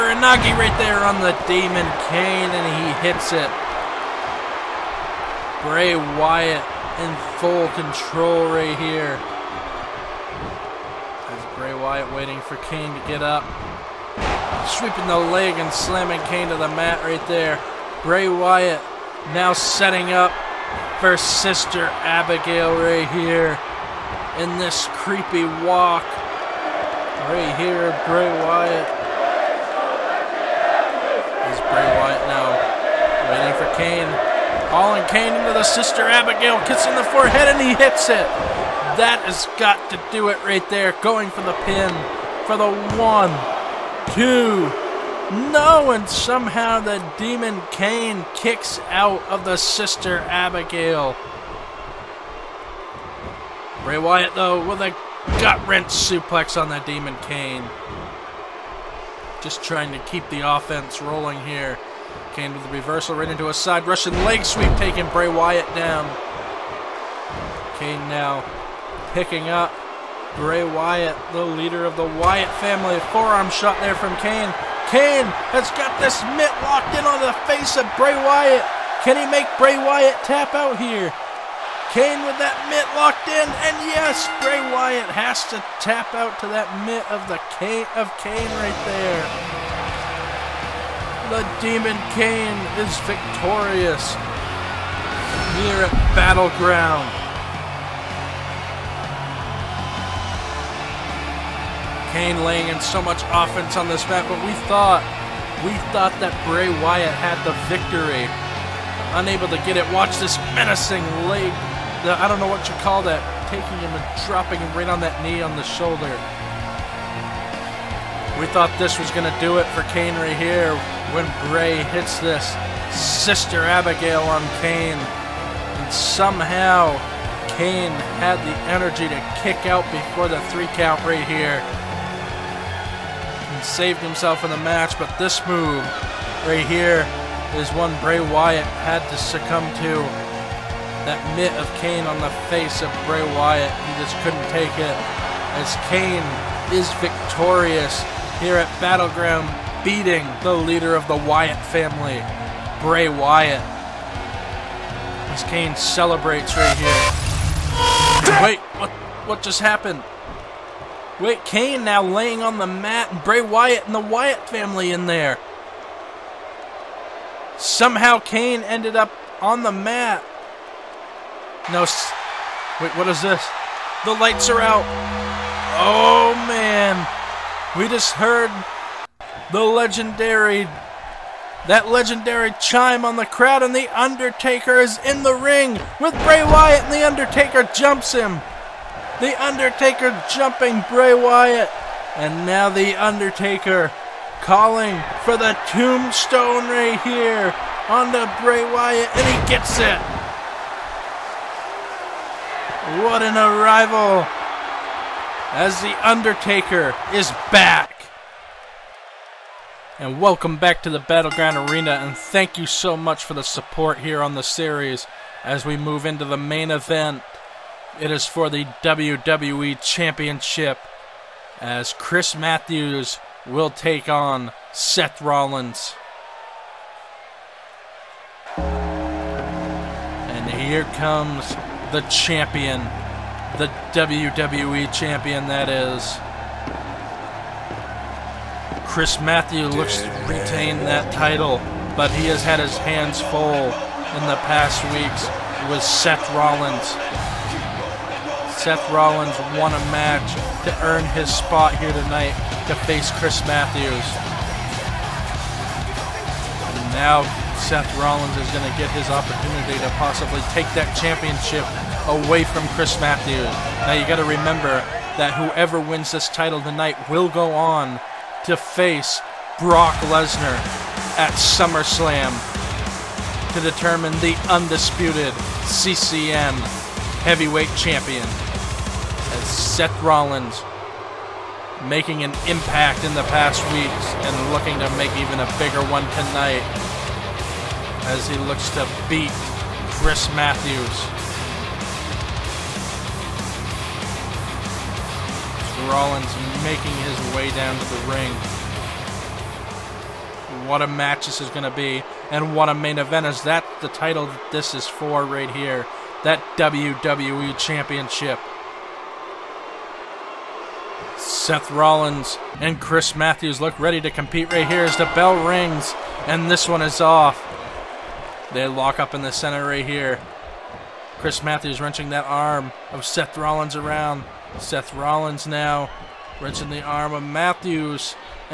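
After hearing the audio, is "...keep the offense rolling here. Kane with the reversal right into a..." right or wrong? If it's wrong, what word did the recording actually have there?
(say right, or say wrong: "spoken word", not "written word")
right.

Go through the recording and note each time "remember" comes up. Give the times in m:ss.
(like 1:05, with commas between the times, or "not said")
4:24.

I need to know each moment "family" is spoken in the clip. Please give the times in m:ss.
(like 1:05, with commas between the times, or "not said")
1:12, 2:31, 2:44.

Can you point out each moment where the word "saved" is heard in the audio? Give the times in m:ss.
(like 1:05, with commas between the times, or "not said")
2:13.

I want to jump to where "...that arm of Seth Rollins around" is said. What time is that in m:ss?
5:22.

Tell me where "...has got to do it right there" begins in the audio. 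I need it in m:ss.
0:39.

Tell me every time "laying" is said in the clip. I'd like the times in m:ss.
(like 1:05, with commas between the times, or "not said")
1:42, 2:42.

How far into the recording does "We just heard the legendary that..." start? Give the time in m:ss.
2:57.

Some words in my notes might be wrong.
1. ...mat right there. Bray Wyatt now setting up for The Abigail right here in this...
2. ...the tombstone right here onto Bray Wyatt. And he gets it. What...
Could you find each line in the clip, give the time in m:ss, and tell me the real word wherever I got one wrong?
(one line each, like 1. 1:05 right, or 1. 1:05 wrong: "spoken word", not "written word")
1. 0:16 wrong: "Sister", not "The"
2. 3:15 right.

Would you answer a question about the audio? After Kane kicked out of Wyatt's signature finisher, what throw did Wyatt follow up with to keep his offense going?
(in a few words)
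Gut wrench suplex.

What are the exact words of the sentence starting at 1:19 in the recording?
Can he make Bray Wyatt tap out here?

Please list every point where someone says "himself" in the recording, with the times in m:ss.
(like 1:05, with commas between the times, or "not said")
2:13.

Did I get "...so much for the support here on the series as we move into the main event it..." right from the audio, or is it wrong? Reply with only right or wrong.
right.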